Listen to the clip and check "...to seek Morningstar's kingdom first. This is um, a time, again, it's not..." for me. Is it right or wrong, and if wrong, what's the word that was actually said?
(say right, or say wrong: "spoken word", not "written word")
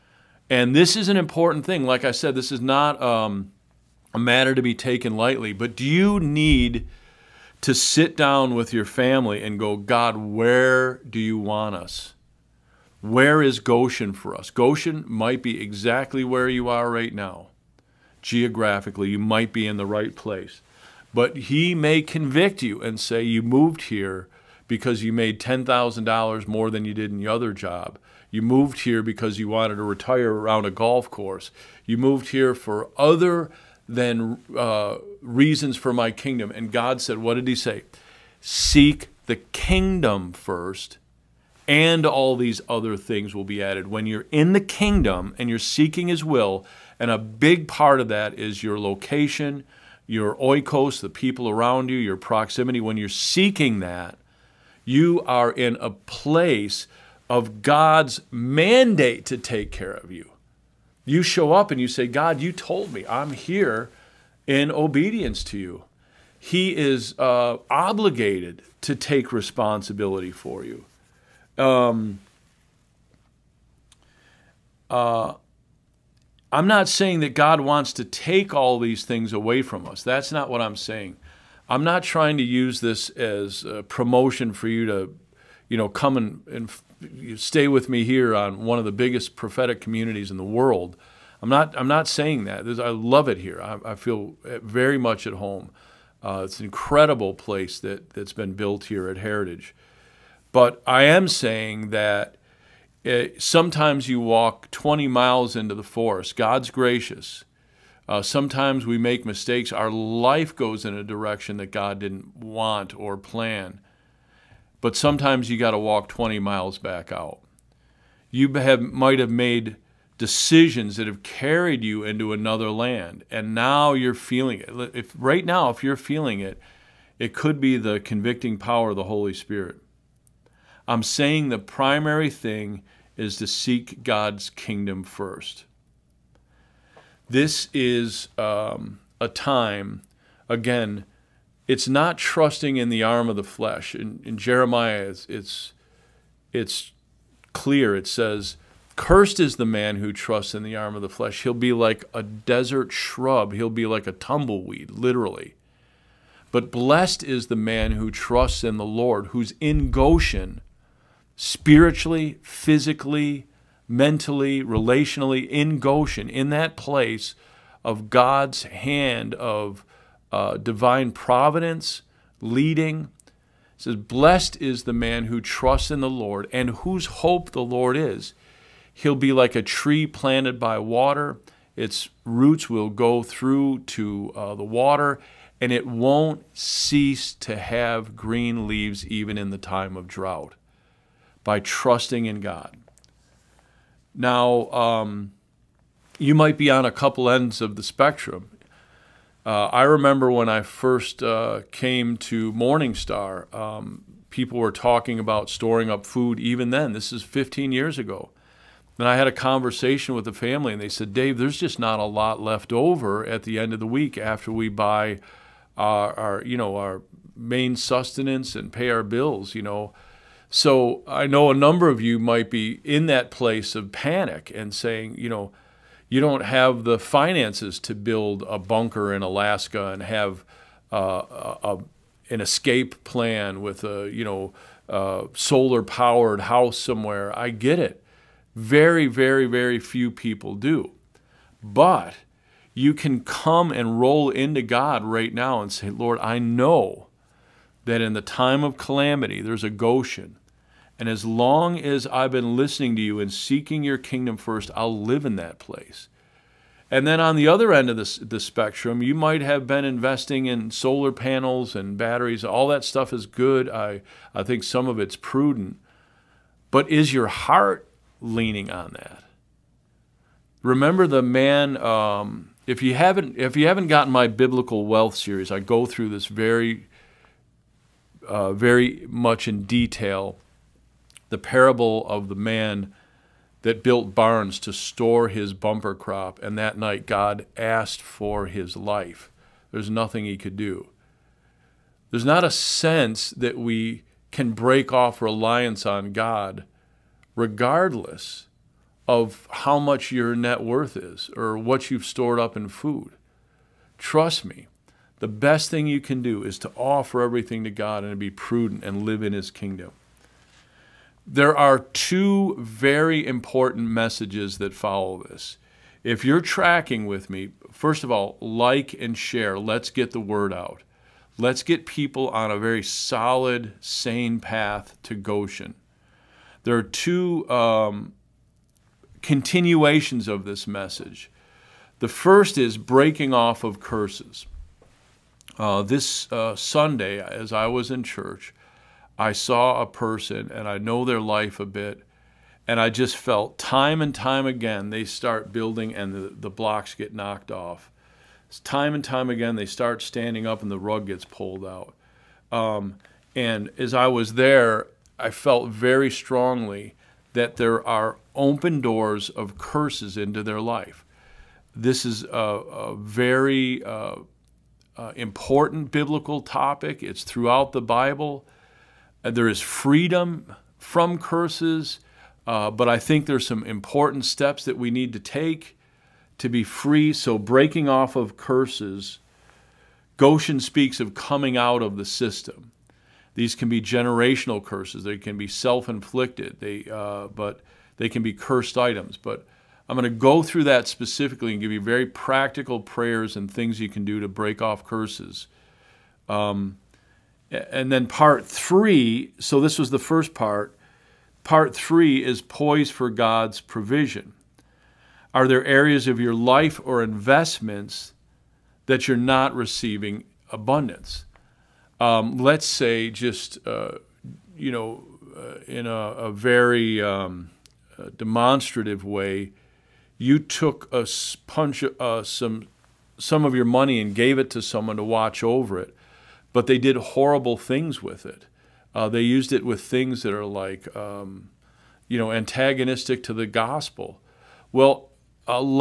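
wrong: "God", not "Morningstar".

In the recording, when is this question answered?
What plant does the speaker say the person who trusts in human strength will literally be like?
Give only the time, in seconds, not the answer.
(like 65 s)
154 s.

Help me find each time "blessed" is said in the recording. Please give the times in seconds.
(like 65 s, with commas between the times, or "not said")
156 s, 173 s.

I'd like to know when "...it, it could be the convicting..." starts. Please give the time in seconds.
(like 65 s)
126 s.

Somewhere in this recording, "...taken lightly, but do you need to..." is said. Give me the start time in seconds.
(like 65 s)
4 s.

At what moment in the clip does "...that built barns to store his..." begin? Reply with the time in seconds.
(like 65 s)
283 s.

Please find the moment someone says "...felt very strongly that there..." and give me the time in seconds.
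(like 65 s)
355 s.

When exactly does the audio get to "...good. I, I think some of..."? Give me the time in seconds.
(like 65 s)
263 s.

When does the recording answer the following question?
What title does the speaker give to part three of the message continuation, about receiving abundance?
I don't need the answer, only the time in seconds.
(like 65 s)
402 s.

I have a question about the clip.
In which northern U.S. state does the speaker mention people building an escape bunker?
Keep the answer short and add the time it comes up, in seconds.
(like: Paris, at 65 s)
Alaska, at 229 s.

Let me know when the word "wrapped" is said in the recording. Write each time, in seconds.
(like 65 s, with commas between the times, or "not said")
not said.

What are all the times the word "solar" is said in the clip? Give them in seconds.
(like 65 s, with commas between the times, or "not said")
235 s, 260 s.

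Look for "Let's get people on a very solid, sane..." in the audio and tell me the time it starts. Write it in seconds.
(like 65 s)
321 s.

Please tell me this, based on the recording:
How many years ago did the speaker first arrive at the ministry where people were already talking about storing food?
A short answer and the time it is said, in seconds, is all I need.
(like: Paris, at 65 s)
15, at 207 s.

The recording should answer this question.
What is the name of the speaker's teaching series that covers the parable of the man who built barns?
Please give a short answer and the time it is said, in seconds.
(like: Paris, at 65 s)
Biblical wealth series, at 274 s.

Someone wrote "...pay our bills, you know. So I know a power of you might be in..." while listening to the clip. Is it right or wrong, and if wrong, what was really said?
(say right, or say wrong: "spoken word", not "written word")
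wrong: "number", not "power".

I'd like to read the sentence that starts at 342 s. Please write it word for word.
And I just felt time and time again they start building and the, the blocks get knocked off.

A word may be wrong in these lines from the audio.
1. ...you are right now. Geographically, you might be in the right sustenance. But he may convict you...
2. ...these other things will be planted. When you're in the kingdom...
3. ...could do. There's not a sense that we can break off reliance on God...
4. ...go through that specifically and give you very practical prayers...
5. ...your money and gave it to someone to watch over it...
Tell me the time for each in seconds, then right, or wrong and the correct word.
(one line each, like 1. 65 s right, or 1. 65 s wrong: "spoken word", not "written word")
1. 16 s wrong: "place", not "sustenance"
2. 42 s wrong: "added", not "planted"
3. 290 s right
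4. 390 s right
5. 423 s right.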